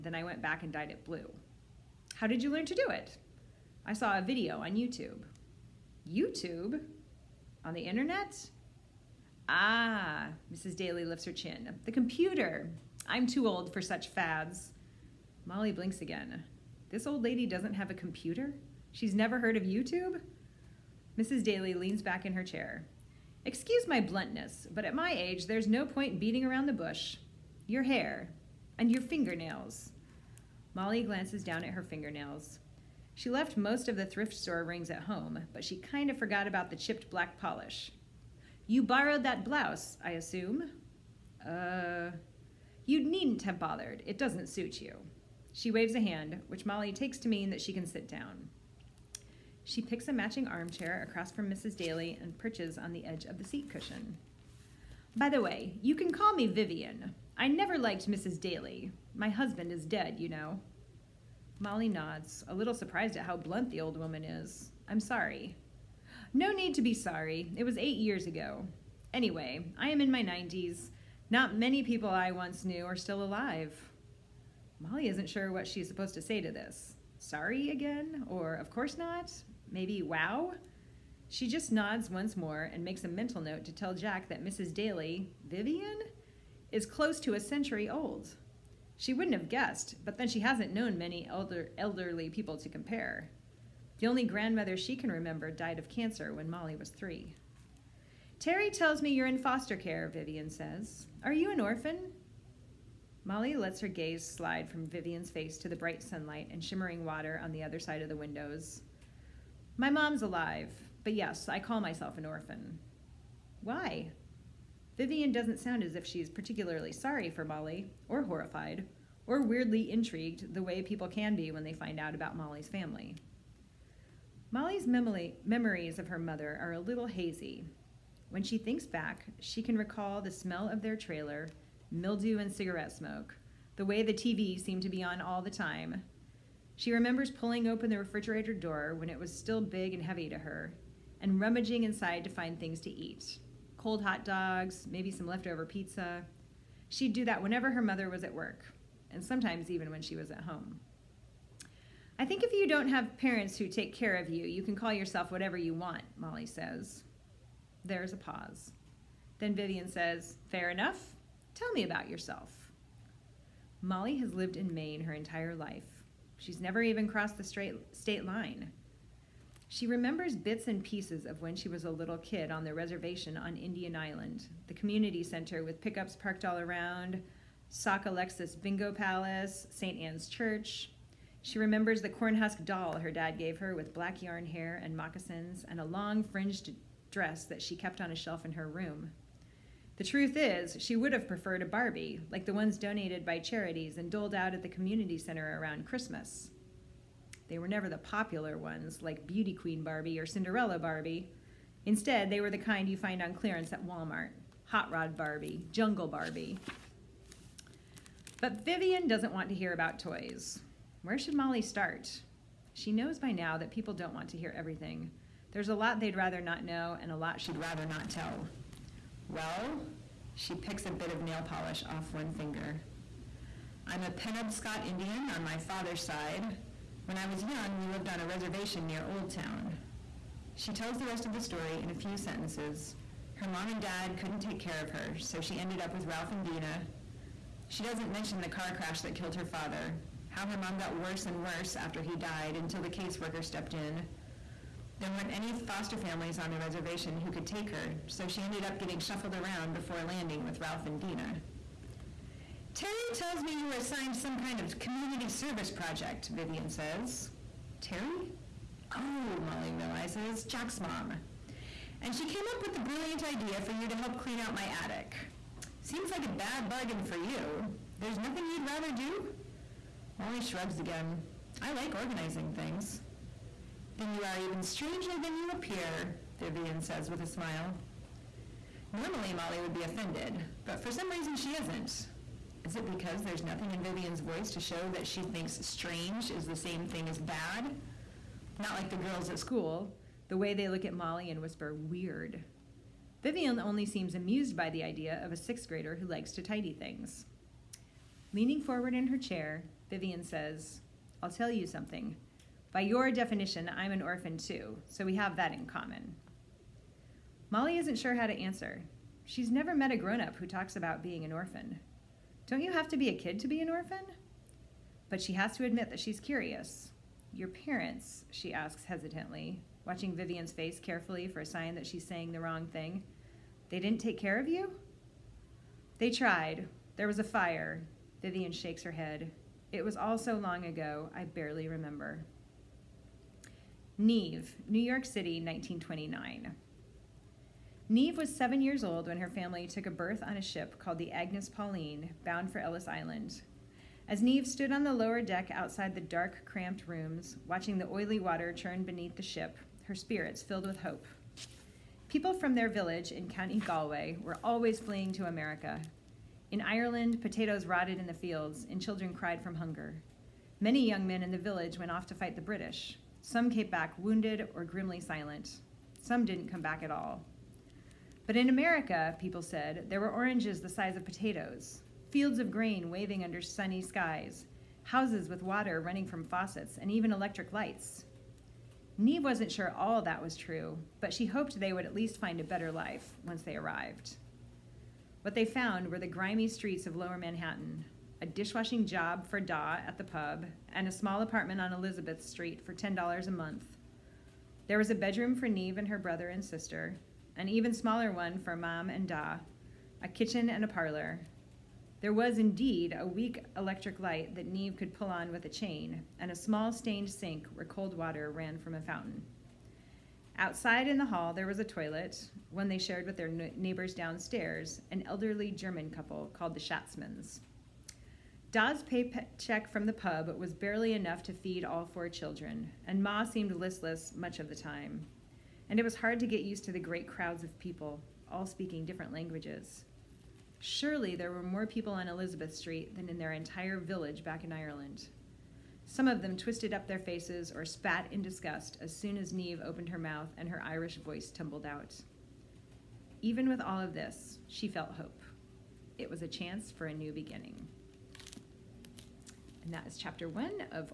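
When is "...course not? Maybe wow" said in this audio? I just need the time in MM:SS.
01:18.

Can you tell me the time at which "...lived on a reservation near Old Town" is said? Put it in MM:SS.
03:47.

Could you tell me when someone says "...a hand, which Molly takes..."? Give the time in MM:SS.
00:45.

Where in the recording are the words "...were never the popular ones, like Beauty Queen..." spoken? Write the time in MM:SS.
03:17.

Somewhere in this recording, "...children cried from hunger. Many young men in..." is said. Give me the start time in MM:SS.
05:58.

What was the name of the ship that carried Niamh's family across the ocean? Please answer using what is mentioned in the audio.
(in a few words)
Agnes Pauline.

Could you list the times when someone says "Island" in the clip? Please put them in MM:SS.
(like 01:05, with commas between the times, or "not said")
02:53, 05:42.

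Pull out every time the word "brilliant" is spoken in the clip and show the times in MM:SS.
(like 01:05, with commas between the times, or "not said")
04:22.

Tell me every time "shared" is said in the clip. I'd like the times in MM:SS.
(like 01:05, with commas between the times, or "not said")
06:52.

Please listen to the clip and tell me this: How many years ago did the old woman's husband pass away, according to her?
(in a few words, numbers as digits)
8.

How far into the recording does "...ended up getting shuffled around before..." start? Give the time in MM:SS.
04:08.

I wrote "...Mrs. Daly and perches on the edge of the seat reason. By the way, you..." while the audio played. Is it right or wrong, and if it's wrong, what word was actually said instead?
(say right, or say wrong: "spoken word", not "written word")
wrong: "cushion", not "reason".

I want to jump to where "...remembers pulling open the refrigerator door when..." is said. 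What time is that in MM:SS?
02:16.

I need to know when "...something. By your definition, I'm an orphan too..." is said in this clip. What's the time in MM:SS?
05:01.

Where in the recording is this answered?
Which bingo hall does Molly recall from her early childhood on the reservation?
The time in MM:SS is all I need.
02:57.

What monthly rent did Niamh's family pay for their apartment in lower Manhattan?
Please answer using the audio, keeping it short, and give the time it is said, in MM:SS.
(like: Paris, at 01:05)
$10, at 06:32.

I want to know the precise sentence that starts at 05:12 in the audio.
Don't you have to be a kid to be an orphan?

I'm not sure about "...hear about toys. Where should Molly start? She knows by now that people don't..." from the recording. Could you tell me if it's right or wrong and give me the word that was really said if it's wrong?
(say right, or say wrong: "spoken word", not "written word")
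right.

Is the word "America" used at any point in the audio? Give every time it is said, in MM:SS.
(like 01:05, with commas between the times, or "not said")
05:55, 06:08.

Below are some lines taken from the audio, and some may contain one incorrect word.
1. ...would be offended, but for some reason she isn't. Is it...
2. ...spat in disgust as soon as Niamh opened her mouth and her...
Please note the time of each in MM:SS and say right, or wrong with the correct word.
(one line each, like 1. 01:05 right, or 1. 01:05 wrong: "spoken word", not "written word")
1. 04:39 right
2. 07:17 right.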